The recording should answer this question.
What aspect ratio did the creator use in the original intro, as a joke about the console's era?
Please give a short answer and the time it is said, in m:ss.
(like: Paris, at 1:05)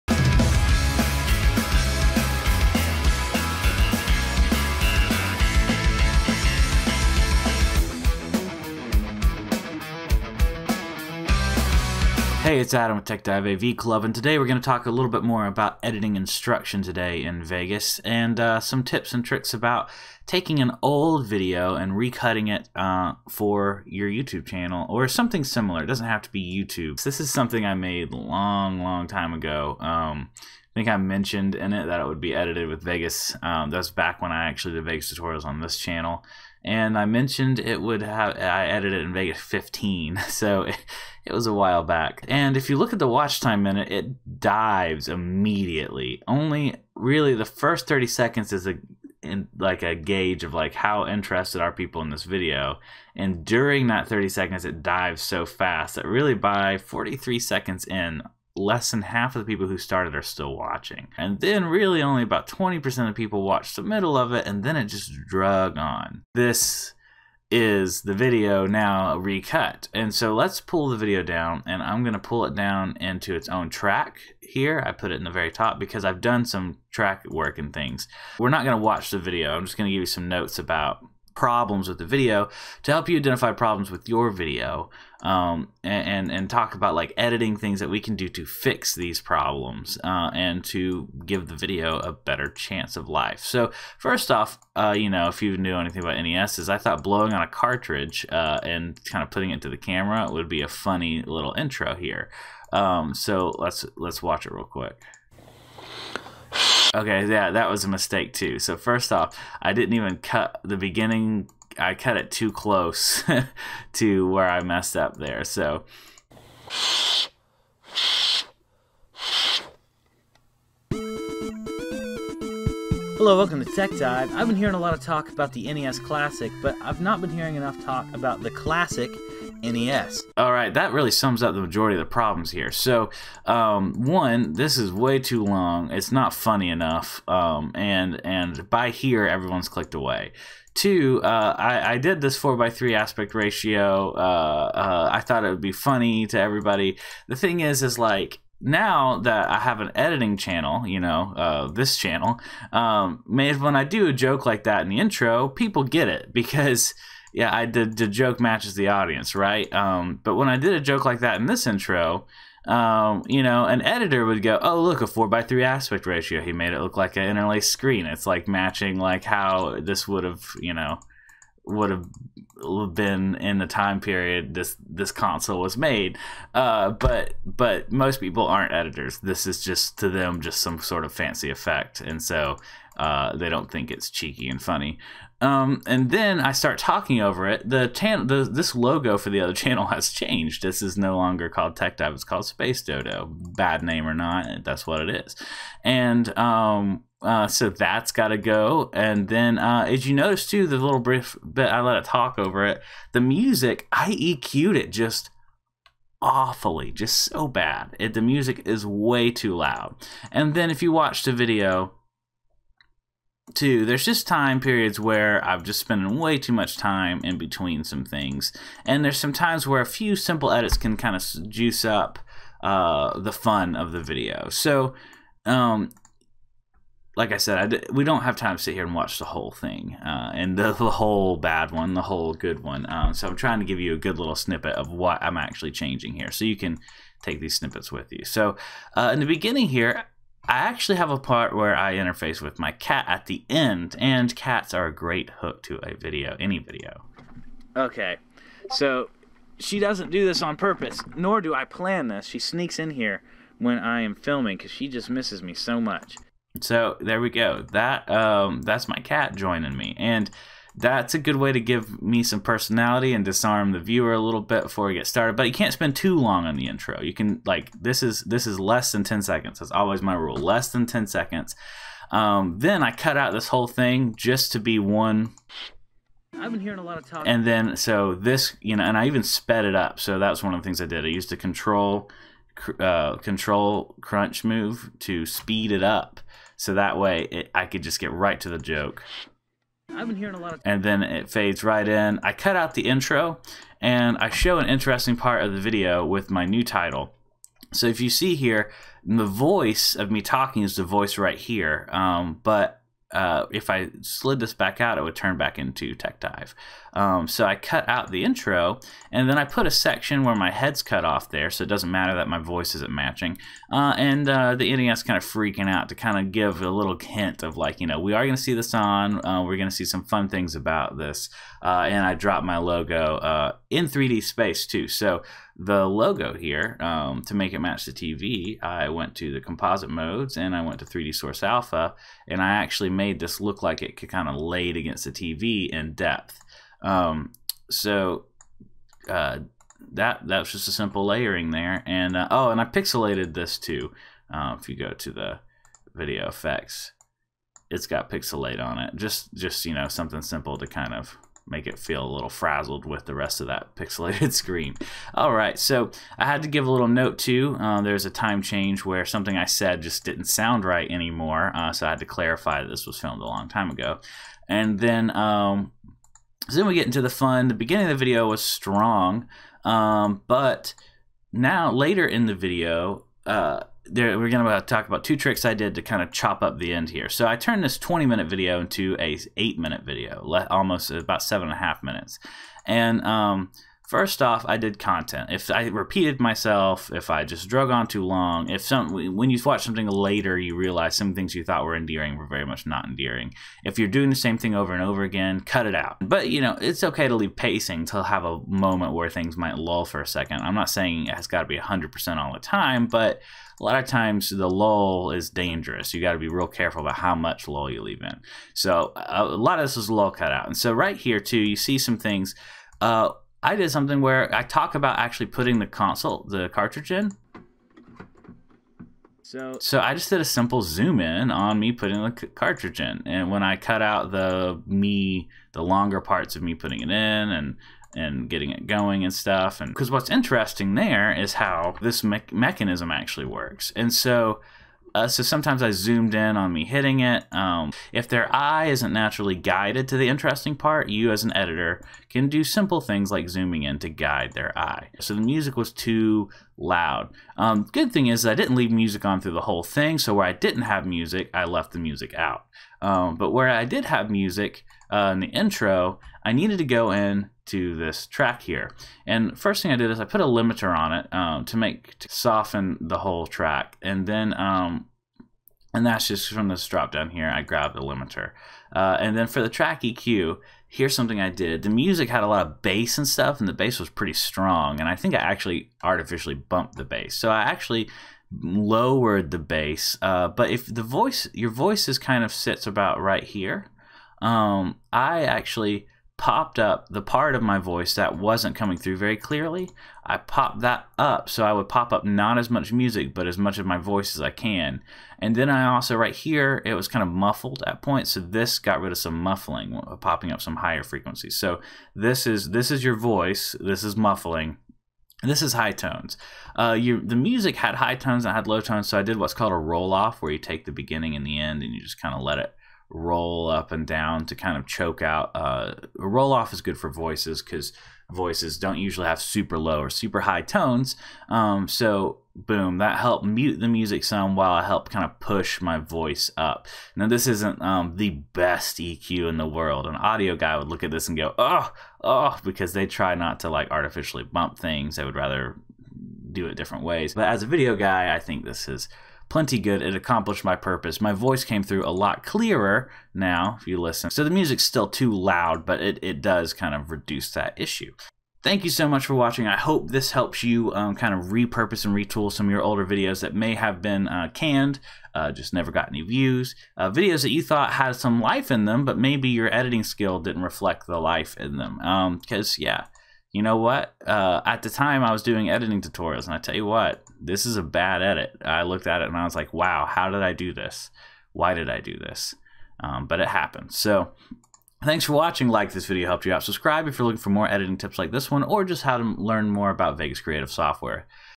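4x3, at 2:22.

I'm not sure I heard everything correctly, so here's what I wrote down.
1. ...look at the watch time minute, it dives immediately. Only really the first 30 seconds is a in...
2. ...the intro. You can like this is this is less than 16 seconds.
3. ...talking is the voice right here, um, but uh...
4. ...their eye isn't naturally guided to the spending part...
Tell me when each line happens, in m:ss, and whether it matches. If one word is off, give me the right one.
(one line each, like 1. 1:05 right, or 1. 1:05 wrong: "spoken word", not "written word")
1. 0:42 right
2. 4:26 wrong: "10", not "16"
3. 5:00 right
4. 7:18 wrong: "interesting", not "spending".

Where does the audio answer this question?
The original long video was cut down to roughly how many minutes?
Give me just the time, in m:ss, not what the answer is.
6:19.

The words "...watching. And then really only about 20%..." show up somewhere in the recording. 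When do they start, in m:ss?
1:00.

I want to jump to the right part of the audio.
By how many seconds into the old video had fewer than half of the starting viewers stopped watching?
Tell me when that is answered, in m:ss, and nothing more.
0:56.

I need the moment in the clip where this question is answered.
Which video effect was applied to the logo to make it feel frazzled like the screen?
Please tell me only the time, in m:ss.
5:48.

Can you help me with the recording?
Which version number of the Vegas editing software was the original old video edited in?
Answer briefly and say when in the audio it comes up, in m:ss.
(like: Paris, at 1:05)
15, at 0:39.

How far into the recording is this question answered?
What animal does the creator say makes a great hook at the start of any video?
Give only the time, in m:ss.
4:04.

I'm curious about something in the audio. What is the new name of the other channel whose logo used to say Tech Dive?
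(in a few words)
Space Dodo.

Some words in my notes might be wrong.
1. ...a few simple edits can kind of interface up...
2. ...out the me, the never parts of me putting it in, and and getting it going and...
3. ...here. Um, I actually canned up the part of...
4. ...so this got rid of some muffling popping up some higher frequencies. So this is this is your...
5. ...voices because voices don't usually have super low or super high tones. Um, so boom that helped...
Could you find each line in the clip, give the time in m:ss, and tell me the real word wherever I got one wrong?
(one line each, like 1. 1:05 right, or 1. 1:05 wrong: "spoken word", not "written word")
1. 3:39 wrong: "juice", not "interface"
2. 7:03 wrong: "longer", not "never"
3. 8:03 wrong: "popped", not "canned"
4. 8:18 right
5. 8:36 right.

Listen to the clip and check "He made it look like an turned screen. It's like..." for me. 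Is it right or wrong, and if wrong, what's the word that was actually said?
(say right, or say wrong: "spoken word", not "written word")
wrong: "interlaced", not "turned".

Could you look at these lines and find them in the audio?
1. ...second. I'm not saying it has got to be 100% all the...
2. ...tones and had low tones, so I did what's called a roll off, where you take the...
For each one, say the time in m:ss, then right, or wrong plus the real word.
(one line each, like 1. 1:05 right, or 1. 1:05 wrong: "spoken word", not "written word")
1. 6:40 right
2. 8:27 right.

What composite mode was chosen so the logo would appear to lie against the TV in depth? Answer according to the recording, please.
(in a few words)
3D Source Alpha.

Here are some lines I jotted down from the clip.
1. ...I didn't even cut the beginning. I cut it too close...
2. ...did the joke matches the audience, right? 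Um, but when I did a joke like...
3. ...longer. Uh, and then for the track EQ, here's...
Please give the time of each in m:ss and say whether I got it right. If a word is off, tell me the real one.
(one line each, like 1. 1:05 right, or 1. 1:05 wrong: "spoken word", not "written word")
1. 1:49 right
2. 2:37 right
3. 7:47 wrong: "limiter", not "longer".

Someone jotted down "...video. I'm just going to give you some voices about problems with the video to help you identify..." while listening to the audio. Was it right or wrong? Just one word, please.
wrong.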